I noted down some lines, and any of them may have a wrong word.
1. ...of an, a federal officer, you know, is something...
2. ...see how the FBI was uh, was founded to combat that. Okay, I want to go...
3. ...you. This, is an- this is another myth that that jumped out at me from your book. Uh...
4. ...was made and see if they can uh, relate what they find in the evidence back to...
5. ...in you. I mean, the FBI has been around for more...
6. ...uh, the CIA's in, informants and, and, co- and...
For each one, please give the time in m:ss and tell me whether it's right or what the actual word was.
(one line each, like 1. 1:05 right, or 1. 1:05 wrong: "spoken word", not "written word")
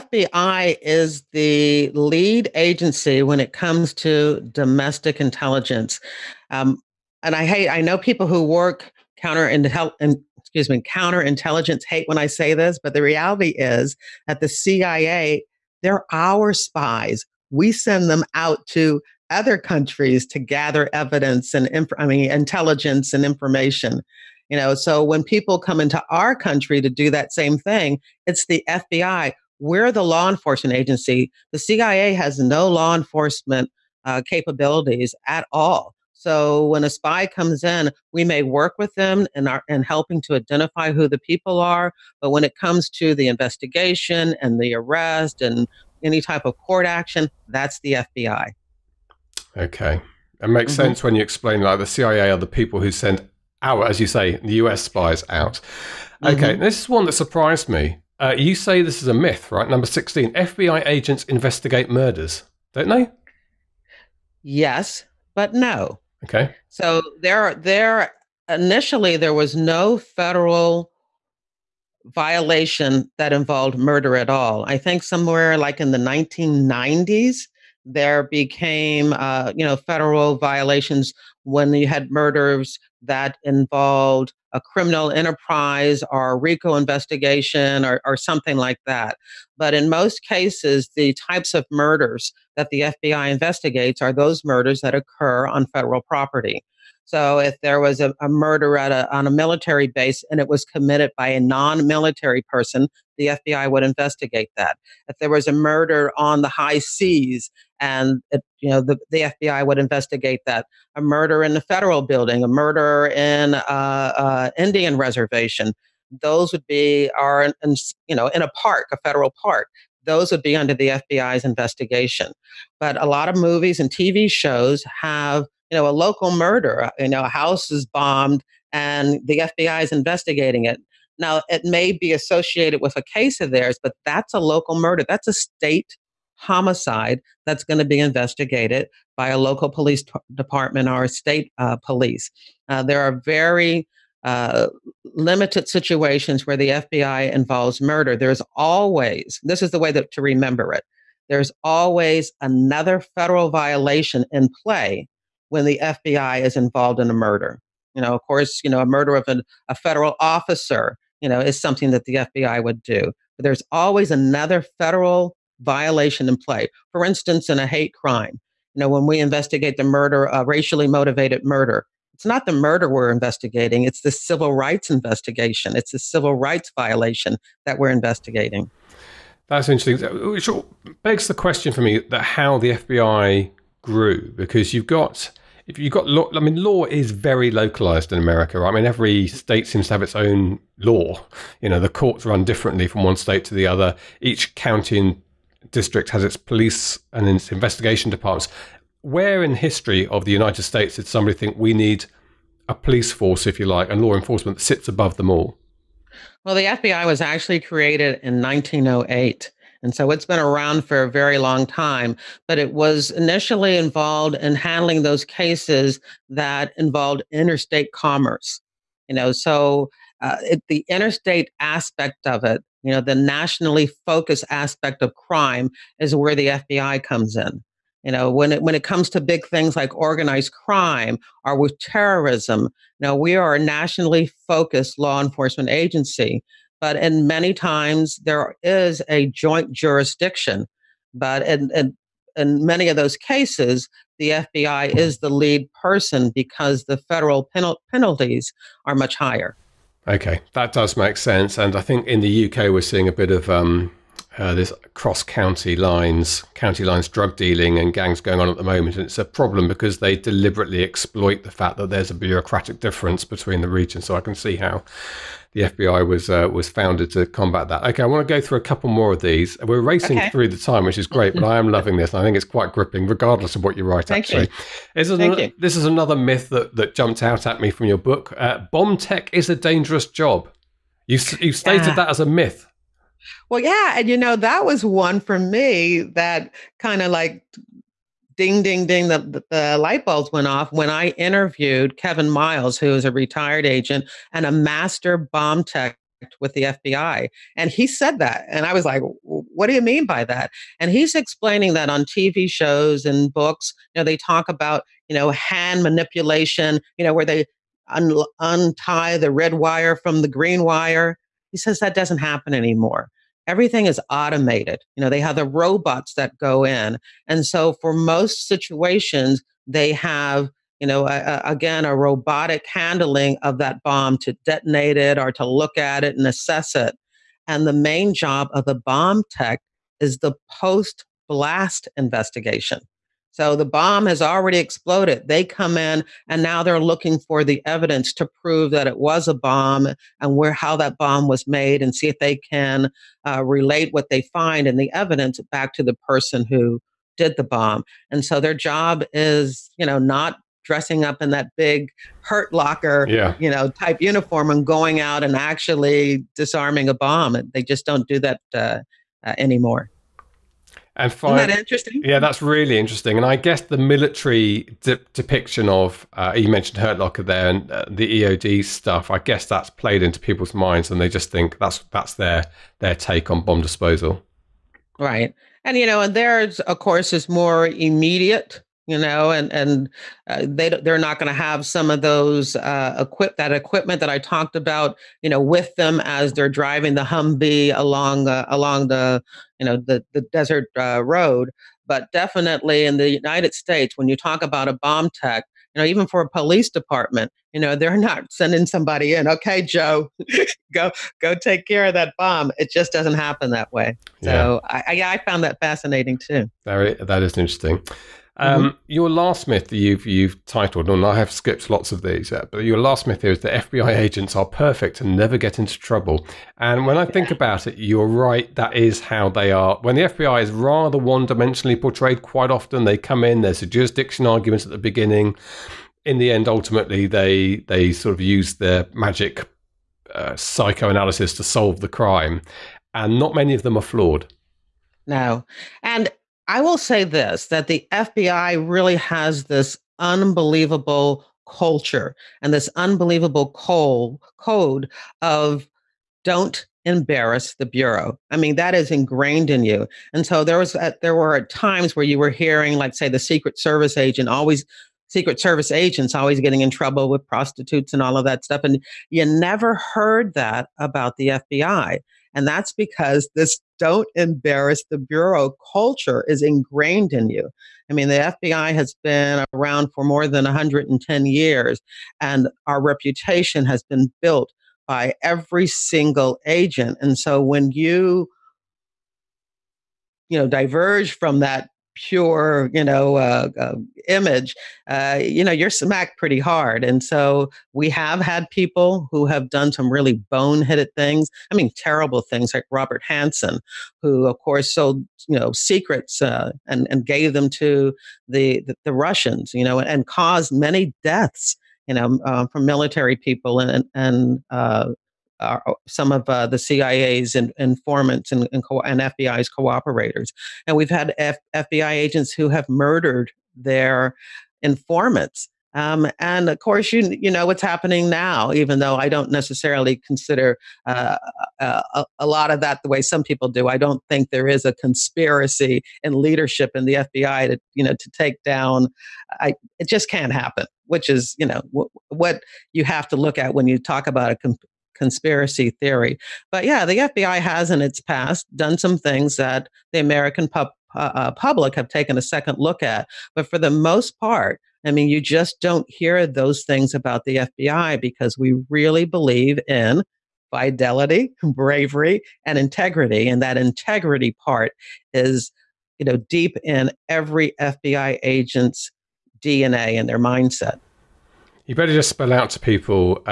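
1. 2:39 right
2. 4:24 right
3. 4:34 right
4. 5:41 right
5. 7:47 right
6. 8:26 right.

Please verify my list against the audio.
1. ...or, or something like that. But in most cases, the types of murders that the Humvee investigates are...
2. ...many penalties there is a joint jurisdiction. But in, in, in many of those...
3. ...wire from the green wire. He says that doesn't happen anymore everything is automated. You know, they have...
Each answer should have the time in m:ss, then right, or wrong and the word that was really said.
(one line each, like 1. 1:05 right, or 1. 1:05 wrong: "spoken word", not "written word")
1. 1:27 wrong: "FBI", not "Humvee"
2. 3:57 wrong: "times", not "penalties"
3. 5:09 right.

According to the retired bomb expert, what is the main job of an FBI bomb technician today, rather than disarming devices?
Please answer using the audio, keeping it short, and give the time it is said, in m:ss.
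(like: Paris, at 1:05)
post blast investigation, at 5:30.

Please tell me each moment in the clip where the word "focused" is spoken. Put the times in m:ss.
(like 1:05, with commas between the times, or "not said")
3:44, 3:54.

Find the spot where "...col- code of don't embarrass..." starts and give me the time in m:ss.
7:23.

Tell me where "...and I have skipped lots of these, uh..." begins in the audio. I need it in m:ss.
6:50.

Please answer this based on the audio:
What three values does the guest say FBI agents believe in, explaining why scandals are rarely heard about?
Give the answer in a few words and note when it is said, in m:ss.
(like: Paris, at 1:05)
fidelity, bravery, and integrity, at 9:10.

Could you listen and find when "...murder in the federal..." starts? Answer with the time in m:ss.
1:51.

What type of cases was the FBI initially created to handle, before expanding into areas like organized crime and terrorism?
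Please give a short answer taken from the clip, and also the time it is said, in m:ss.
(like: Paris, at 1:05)
interstate commerce, at 3:37.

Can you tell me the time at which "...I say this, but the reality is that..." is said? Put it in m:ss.
0:12.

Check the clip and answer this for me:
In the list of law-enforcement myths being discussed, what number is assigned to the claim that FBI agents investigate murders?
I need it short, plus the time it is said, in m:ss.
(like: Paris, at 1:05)
16, at 0:59.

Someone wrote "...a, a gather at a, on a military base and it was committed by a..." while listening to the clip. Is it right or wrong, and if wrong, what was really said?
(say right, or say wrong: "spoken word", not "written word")
wrong: "murder", not "gather".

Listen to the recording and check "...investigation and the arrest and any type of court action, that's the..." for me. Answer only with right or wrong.
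right.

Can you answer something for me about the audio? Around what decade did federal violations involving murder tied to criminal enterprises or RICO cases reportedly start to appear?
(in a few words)
1990s.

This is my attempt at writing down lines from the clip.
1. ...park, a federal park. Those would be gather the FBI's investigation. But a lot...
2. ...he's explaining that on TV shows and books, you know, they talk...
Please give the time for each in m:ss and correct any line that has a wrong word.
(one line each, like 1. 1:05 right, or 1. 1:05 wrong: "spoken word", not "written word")
1. 1:58 wrong: "under", not "gather"
2. 5:00 right.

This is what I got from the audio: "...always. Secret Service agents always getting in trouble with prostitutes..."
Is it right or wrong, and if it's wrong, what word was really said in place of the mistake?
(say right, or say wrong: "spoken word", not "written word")
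right.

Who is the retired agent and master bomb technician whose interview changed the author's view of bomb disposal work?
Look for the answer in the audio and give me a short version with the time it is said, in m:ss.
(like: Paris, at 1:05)
Kevin Miles, at 4:51.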